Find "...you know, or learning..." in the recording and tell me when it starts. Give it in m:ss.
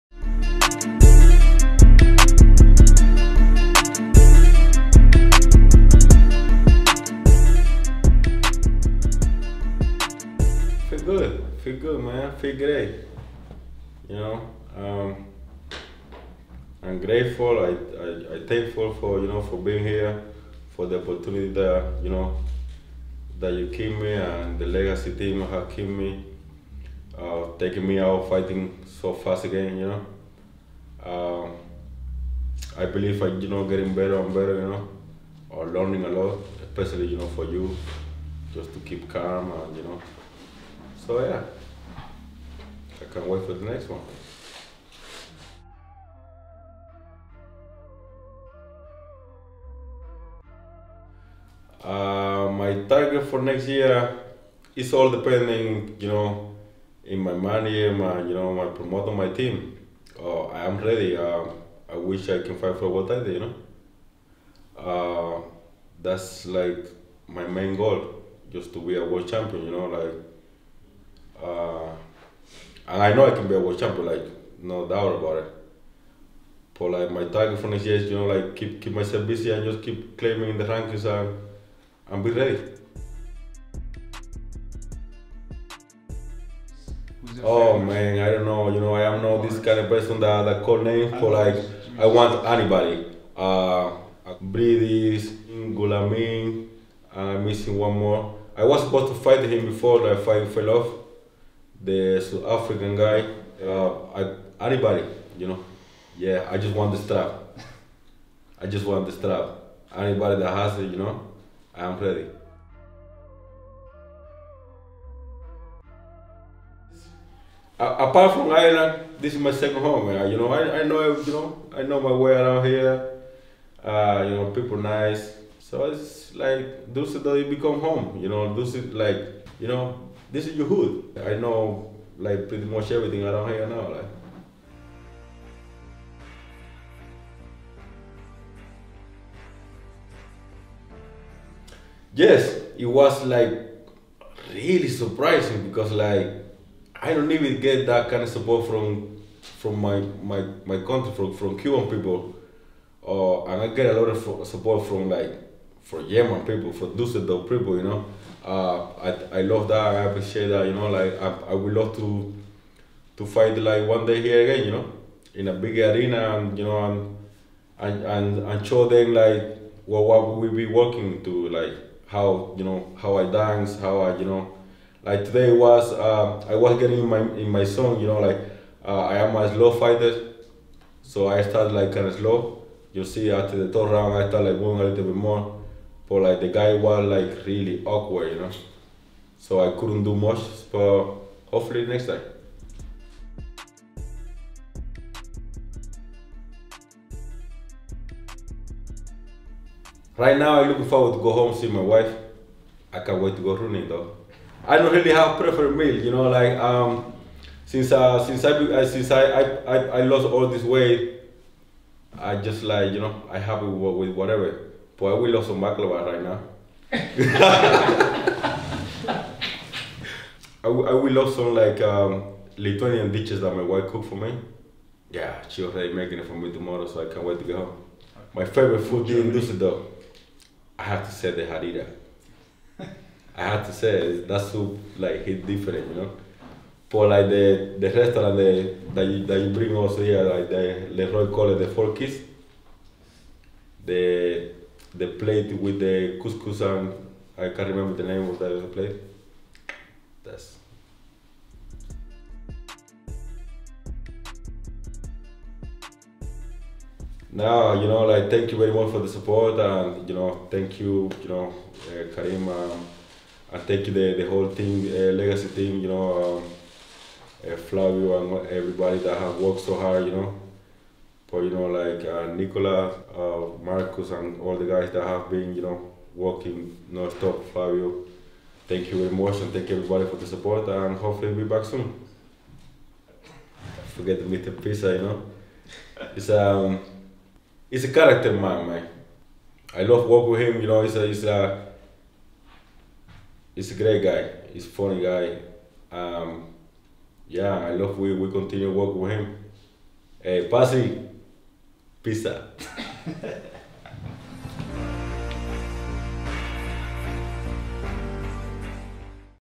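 0:34.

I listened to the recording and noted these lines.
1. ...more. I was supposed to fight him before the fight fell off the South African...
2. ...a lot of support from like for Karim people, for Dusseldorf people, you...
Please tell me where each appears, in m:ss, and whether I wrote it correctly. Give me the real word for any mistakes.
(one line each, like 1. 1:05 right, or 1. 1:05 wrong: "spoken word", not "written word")
1. 1:37 right
2. 2:33 wrong: "German", not "Karim".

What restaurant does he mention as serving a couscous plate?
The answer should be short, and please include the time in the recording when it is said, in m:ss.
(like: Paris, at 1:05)
Four Keys, at 4:01.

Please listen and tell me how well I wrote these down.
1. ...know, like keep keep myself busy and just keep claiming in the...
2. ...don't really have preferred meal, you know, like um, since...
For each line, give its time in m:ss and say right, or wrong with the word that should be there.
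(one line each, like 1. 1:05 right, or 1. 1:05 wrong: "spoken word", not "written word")
1. 1:18 right
2. 3:24 right.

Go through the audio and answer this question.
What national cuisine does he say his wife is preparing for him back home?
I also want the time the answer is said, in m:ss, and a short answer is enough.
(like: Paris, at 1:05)
Lithuanian, at 3:42.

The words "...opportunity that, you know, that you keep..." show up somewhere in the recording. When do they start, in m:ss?
0:21.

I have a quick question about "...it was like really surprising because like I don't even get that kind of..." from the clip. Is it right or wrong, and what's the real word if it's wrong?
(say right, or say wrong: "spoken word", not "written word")
right.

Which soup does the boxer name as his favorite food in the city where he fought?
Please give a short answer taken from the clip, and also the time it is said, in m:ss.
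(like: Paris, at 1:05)
harira, at 3:51.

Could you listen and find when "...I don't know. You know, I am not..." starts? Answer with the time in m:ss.
1:28.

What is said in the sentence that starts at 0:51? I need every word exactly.
Uh, my target for next year is all depending, you know, in my money, my you know, my promoter, my team.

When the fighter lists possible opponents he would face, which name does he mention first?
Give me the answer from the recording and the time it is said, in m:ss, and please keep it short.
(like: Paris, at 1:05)
Briedis, at 1:34.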